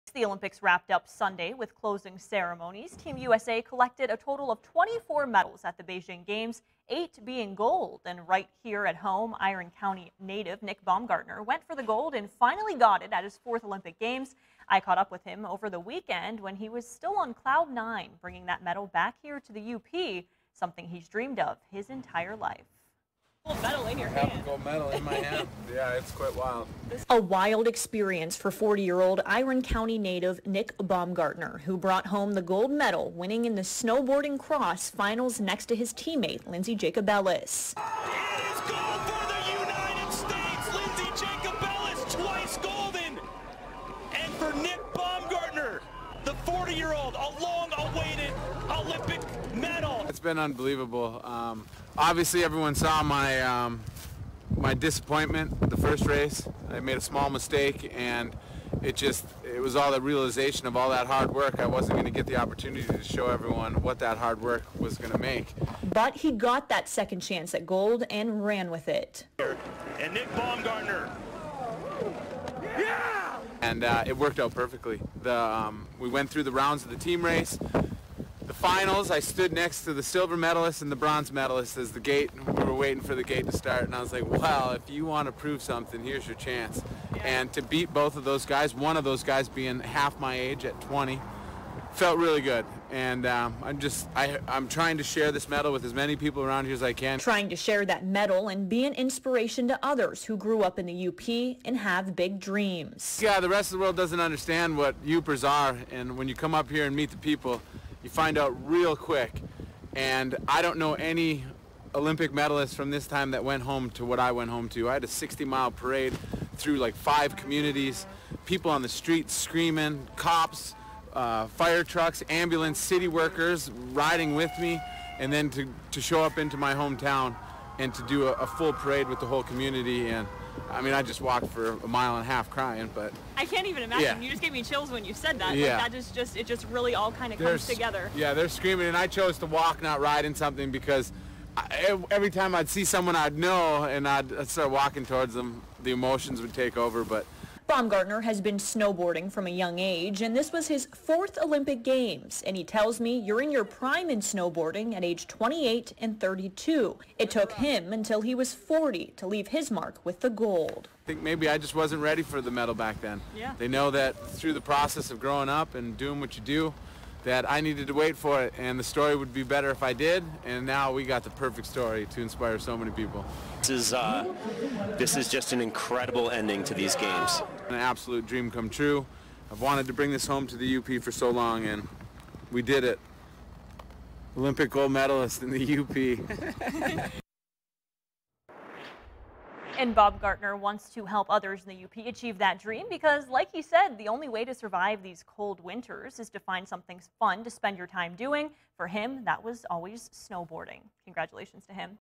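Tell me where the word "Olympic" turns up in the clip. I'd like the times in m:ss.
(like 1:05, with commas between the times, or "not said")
0:00, 0:13, 0:48, 1:51, 2:31, 3:04.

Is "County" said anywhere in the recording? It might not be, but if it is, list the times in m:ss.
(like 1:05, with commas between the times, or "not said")
0:09, 0:29.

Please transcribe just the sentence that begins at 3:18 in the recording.
For him, that was always snowboarding.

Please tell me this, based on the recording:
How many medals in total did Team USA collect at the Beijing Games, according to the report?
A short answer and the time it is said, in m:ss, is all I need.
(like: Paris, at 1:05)
24, at 0:04.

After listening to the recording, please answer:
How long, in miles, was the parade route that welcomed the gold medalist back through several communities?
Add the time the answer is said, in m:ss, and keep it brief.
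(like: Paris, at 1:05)
60 miles, at 1:55.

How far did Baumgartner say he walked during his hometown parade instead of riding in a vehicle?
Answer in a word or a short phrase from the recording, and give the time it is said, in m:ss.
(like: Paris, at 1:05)
A mile and a half, at 2:11.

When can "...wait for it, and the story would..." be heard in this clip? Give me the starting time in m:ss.
2:47.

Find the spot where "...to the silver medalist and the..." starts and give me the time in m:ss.
1:19.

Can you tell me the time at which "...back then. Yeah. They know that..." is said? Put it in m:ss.
2:42.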